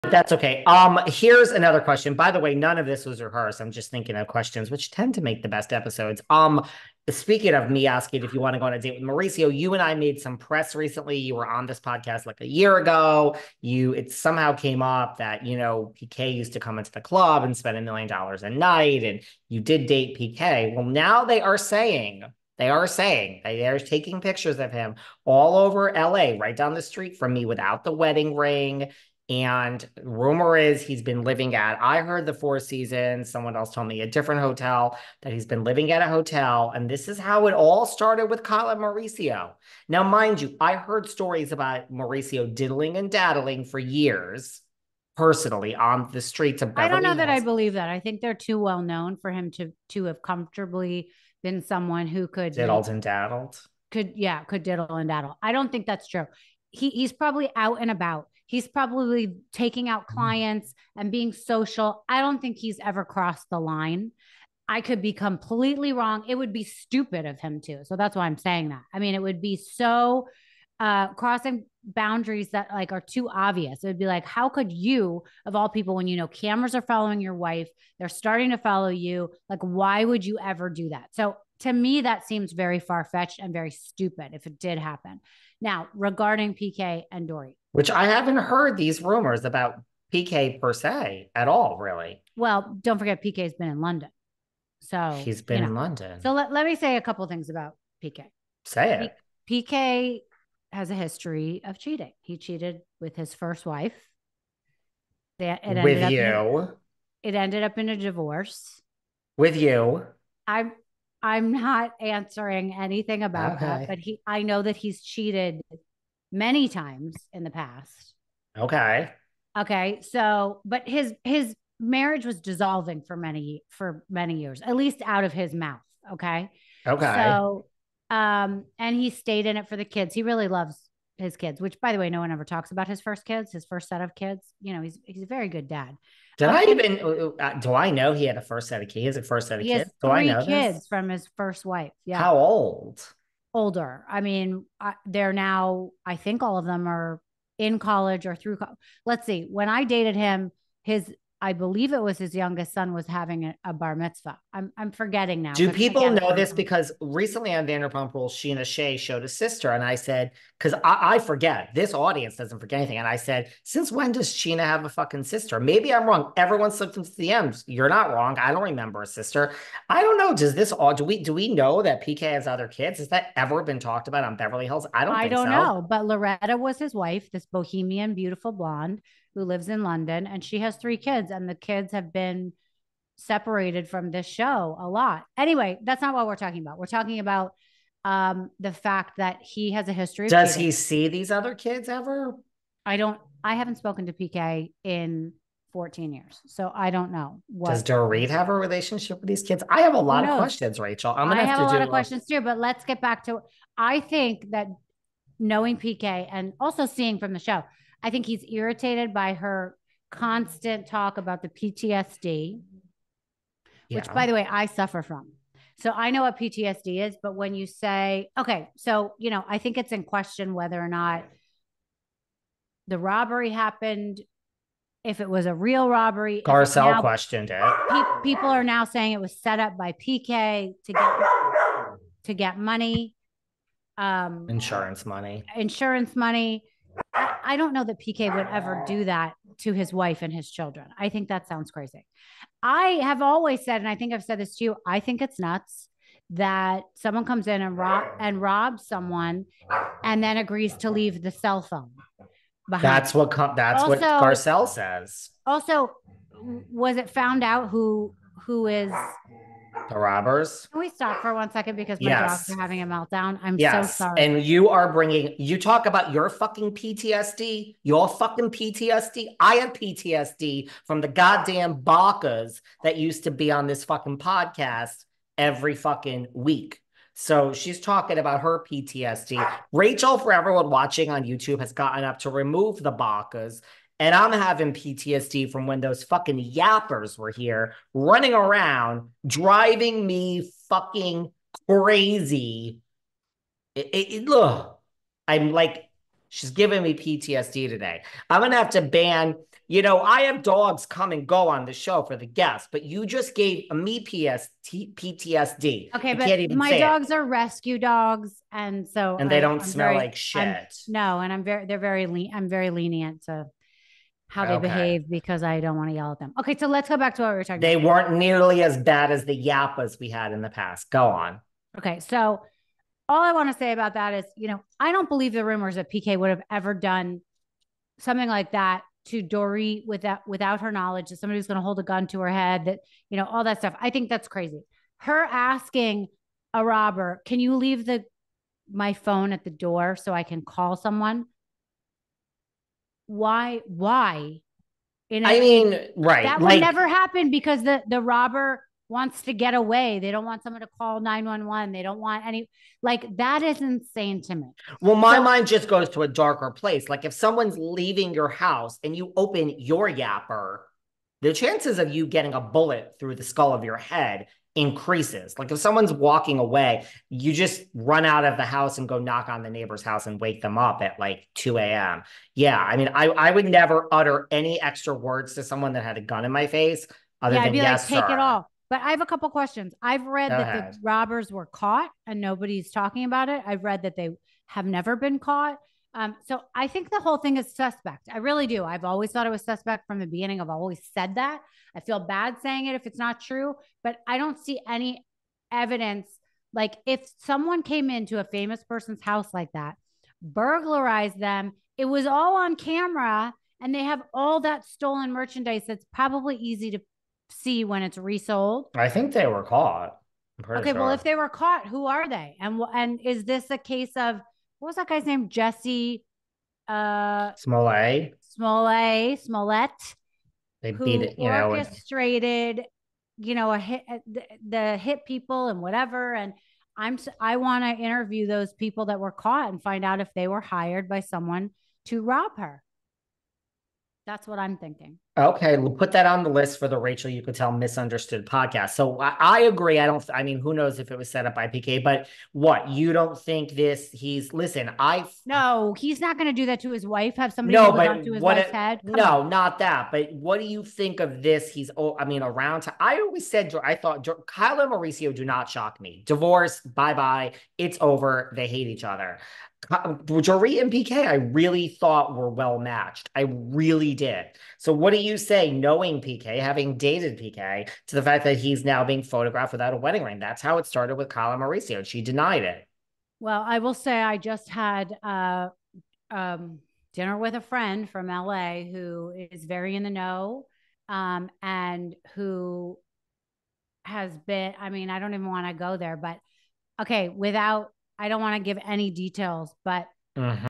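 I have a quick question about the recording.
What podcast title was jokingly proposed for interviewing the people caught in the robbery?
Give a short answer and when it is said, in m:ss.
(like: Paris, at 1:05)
Rachel Uchitel Misunderstood, at 7:16.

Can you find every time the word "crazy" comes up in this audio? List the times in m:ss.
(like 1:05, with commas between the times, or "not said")
4:01, 4:51, 5:34.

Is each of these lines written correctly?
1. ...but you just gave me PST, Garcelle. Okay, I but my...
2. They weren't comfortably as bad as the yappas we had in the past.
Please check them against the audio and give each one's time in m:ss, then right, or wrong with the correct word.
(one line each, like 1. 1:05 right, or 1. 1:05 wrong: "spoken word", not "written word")
1. 5:02 wrong: "PTSD", not "Garcelle"
2. 5:17 wrong: "nearly", not "comfortably".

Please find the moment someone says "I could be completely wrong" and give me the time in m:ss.
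1:04.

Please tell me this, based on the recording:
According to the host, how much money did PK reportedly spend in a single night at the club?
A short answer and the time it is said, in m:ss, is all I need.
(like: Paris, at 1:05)
a million dollars, at 0:17.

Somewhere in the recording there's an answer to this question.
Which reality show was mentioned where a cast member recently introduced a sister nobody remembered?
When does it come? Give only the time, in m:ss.
2:37.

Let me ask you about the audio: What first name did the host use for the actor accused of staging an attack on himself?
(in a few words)
Jesse.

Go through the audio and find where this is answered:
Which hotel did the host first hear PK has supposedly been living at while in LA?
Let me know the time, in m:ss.
0:32.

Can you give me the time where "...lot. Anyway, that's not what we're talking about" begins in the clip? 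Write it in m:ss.
3:04.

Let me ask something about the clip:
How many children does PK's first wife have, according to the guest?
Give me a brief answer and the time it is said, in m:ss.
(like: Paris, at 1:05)
3, at 3:00.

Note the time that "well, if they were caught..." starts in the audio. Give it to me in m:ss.
6:50.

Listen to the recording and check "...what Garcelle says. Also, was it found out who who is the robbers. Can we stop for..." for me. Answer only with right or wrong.
right.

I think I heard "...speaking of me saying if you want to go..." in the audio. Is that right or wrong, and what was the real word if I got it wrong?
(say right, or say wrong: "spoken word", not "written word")
wrong: "asking", not "saying".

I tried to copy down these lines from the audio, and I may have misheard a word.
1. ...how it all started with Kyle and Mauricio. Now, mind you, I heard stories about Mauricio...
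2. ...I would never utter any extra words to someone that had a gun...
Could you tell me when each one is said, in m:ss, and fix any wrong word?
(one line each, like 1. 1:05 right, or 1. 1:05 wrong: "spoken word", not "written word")
1. 0:37 right
2. 6:13 right.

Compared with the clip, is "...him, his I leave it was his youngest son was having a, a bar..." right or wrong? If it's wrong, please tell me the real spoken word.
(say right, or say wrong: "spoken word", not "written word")
wrong: "believe", not "leave".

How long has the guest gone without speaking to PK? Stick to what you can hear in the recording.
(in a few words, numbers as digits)
14 years.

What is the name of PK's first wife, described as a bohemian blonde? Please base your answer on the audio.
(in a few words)
Loretta.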